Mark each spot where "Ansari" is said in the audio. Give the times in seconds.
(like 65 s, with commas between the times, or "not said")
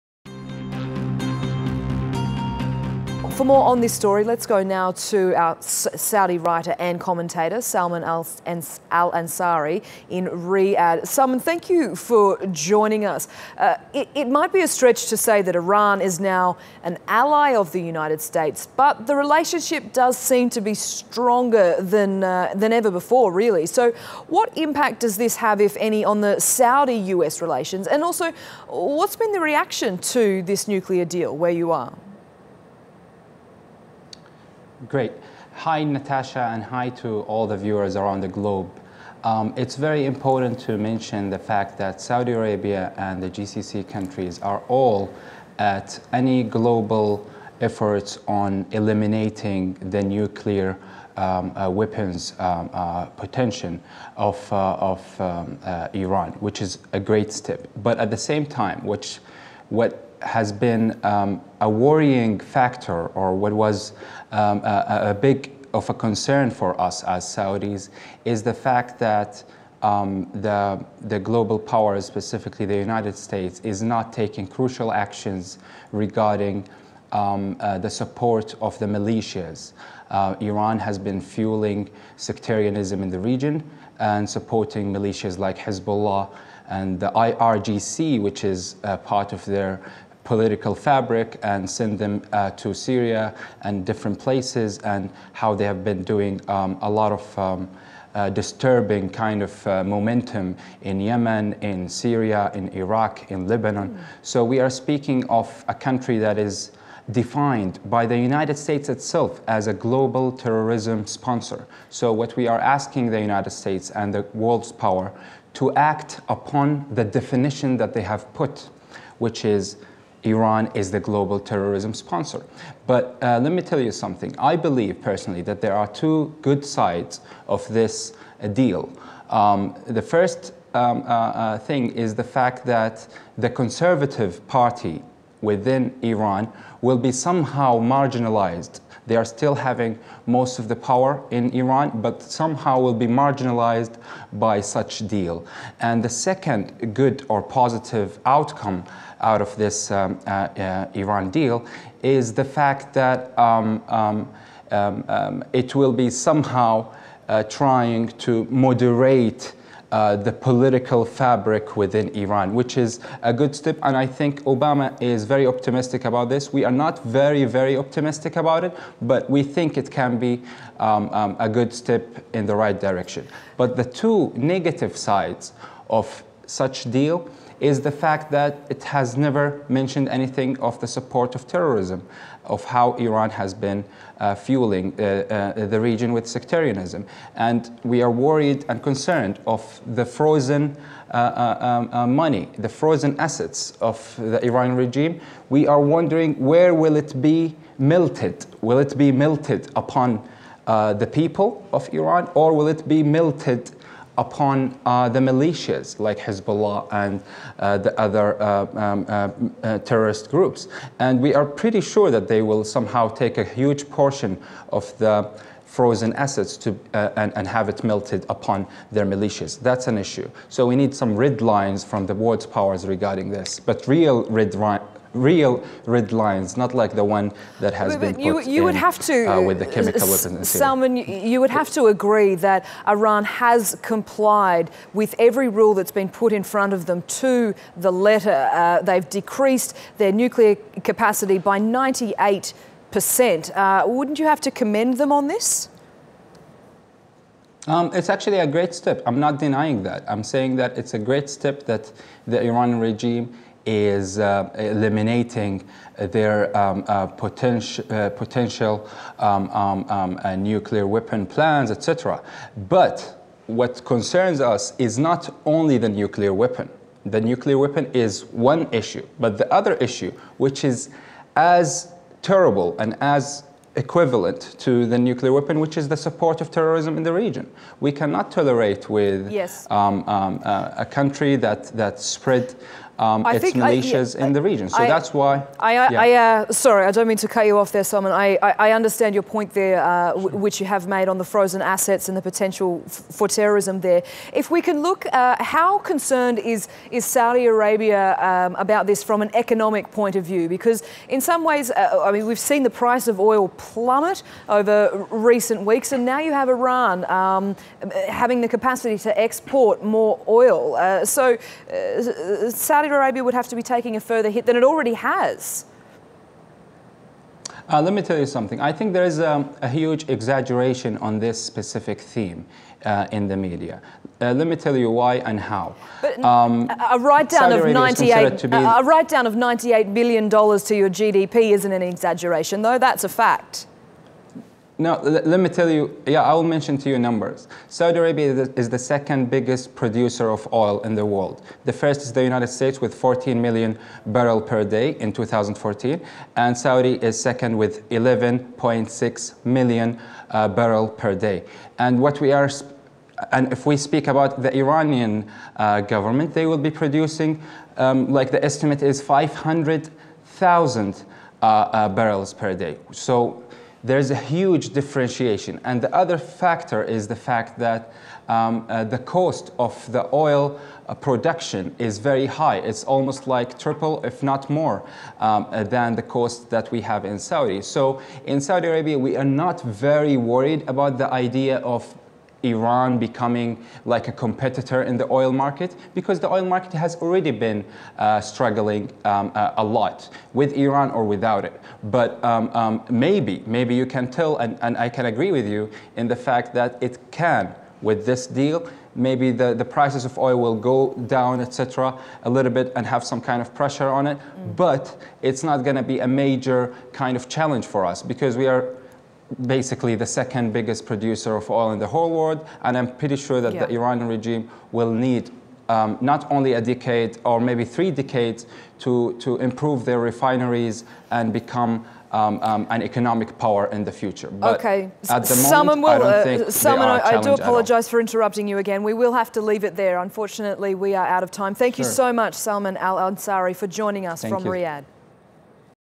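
8 s, 432 s.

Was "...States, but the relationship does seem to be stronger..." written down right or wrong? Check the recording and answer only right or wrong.
right.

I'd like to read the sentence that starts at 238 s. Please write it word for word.
Uh, they've decreased their nuclear capacity by 98 percent.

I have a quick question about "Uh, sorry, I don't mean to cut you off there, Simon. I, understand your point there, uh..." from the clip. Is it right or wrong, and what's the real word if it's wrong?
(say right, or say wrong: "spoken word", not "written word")
right.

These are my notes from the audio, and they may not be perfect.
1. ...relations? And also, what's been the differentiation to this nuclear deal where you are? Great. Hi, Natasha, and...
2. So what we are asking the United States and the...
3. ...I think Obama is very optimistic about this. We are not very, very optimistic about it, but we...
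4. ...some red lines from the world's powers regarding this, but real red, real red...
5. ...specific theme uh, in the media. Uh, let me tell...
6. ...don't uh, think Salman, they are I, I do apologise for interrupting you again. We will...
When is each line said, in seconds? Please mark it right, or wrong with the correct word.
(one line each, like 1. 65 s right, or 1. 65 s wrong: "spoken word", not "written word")
1. 27 s wrong: "reaction", not "differentiation"
2. 111 s right
3. 163 s right
4. 221 s right
5. 321 s right
6. 426 s right.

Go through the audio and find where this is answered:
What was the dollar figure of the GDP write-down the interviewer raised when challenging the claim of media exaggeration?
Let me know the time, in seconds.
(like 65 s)
329 s.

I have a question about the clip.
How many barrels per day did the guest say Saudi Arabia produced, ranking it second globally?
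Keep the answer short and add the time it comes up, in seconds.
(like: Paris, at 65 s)
11.6 million, at 347 s.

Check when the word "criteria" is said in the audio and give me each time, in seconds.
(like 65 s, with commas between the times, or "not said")
not said.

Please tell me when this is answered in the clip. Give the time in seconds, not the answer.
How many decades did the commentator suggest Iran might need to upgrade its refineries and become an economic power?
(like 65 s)
417 s.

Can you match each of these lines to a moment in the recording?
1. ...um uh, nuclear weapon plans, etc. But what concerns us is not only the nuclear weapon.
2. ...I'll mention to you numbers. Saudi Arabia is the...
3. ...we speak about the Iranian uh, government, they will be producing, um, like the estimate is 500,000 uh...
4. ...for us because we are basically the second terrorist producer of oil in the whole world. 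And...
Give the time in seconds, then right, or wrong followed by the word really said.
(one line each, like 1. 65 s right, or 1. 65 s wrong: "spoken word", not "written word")
1. 259 s right
2. 336 s right
3. 353 s right
4. 407 s wrong: "biggest", not "terrorist".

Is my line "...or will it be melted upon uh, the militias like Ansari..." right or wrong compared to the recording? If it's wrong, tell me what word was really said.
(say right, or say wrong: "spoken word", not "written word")
wrong: "Hezbollah", not "Ansari".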